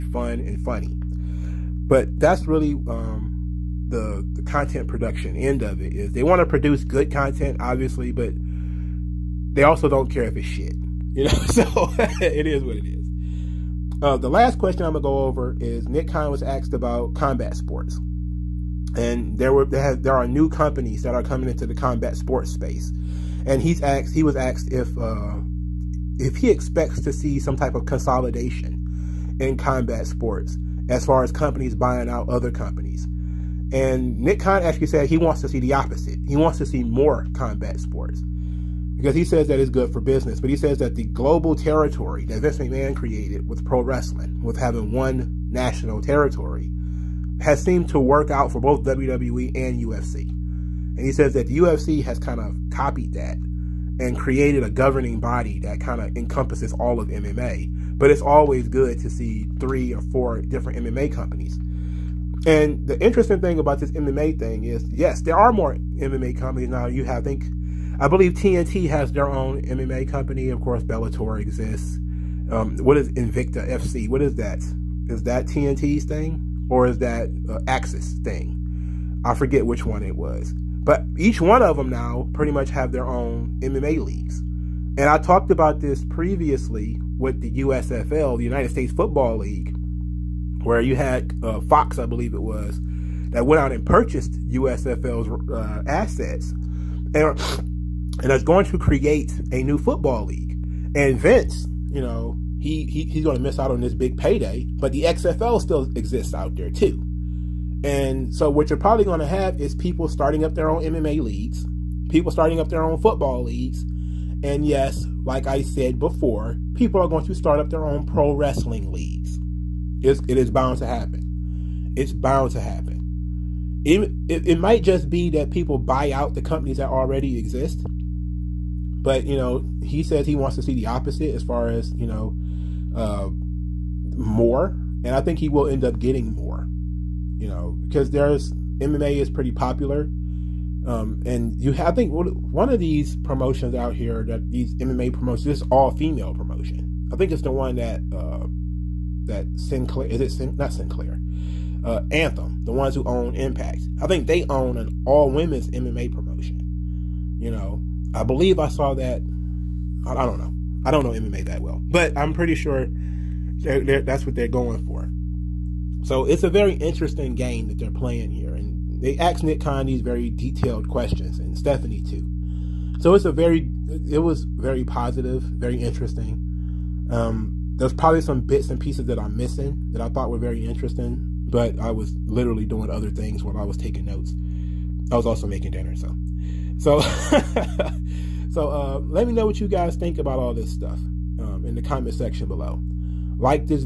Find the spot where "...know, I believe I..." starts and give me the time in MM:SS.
02:37.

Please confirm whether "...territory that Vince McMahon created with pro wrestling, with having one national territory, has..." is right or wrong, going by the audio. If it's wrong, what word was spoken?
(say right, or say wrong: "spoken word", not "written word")
right.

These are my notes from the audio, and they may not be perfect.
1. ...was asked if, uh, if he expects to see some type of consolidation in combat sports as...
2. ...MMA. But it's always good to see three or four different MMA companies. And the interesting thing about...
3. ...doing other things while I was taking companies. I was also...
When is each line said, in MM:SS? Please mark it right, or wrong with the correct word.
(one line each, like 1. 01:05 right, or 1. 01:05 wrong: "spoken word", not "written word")
1. 00:24 right
2. 00:57 right
3. 03:02 wrong: "notes", not "companies".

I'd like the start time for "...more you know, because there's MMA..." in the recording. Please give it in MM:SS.
02:16.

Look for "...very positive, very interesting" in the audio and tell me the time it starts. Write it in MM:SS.
02:54.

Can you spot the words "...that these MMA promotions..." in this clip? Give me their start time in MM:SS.
02:24.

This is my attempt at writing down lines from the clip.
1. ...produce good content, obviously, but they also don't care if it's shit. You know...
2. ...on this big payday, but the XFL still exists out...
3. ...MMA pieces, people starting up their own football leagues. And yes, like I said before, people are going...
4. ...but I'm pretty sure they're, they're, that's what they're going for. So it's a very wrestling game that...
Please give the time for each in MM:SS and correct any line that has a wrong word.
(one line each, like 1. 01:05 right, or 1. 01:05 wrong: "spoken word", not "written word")
1. 00:06 right
2. 01:43 right
3. 01:50 wrong: "leagues", not "pieces"
4. 02:41 wrong: "interesting", not "wrestling".